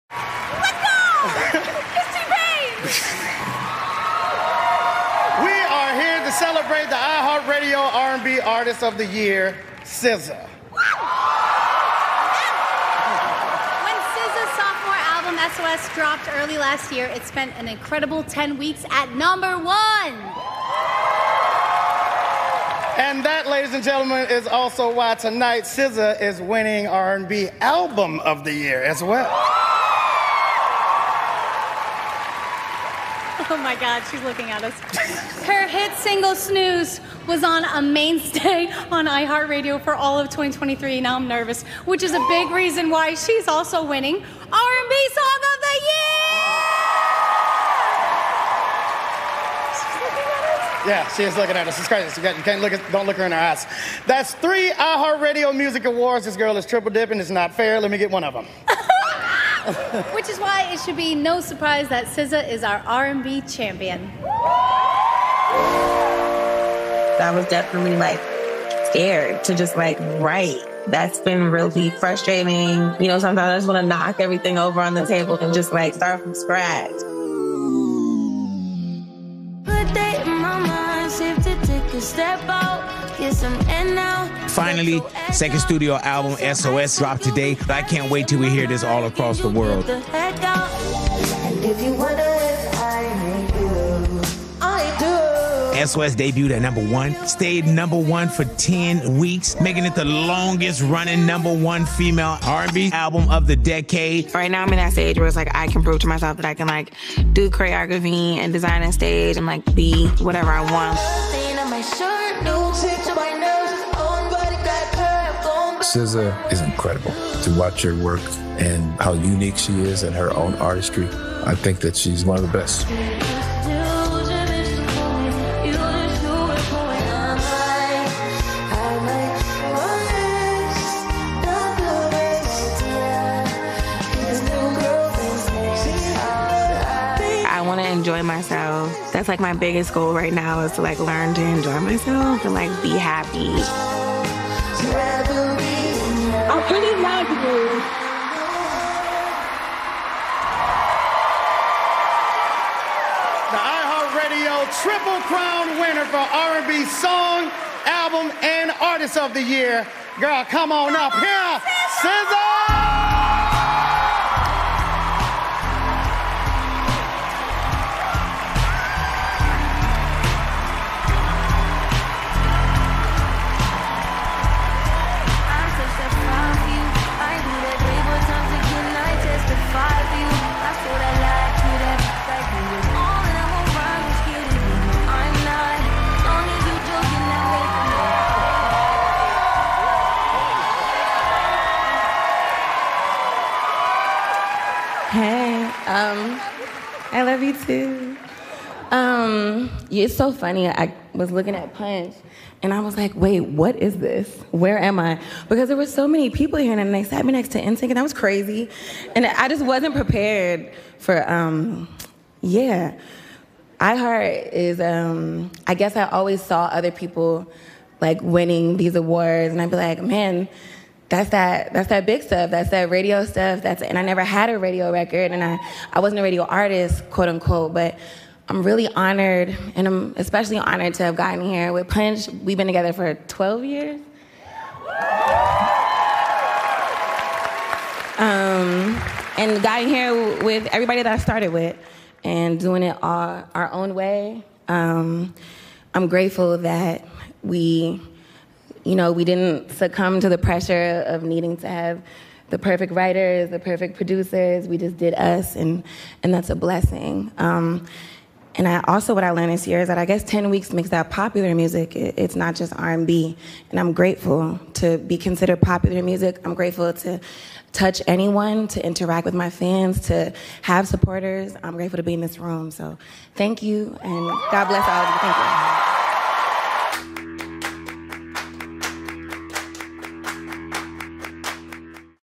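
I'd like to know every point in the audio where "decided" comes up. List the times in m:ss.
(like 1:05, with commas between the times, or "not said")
not said.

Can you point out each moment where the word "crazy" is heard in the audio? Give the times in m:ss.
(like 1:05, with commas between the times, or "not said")
0:51, 3:28.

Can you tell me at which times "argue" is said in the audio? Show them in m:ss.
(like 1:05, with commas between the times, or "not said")
not said.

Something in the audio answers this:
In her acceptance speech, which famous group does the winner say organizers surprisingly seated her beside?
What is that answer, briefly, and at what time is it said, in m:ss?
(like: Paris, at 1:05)
NSYNC, at 3:27.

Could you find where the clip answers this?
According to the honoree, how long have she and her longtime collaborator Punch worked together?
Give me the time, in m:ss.
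3:53.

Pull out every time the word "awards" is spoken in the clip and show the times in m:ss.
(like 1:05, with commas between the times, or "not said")
0:55, 3:38.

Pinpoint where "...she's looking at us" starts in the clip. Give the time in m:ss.
0:34.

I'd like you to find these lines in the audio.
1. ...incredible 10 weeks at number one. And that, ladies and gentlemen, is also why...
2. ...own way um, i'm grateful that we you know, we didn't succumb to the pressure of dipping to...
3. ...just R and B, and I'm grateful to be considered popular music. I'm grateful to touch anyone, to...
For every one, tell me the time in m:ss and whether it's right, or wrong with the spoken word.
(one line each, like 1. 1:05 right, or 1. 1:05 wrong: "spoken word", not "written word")
1. 0:17 right
2. 4:03 wrong: "needing", not "dipping"
3. 4:22 right.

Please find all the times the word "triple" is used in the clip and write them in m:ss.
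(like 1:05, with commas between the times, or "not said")
0:56, 2:34.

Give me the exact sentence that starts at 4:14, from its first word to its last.
We just did us, and and that's a blessing.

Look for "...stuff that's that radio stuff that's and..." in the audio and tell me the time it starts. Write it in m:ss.
3:42.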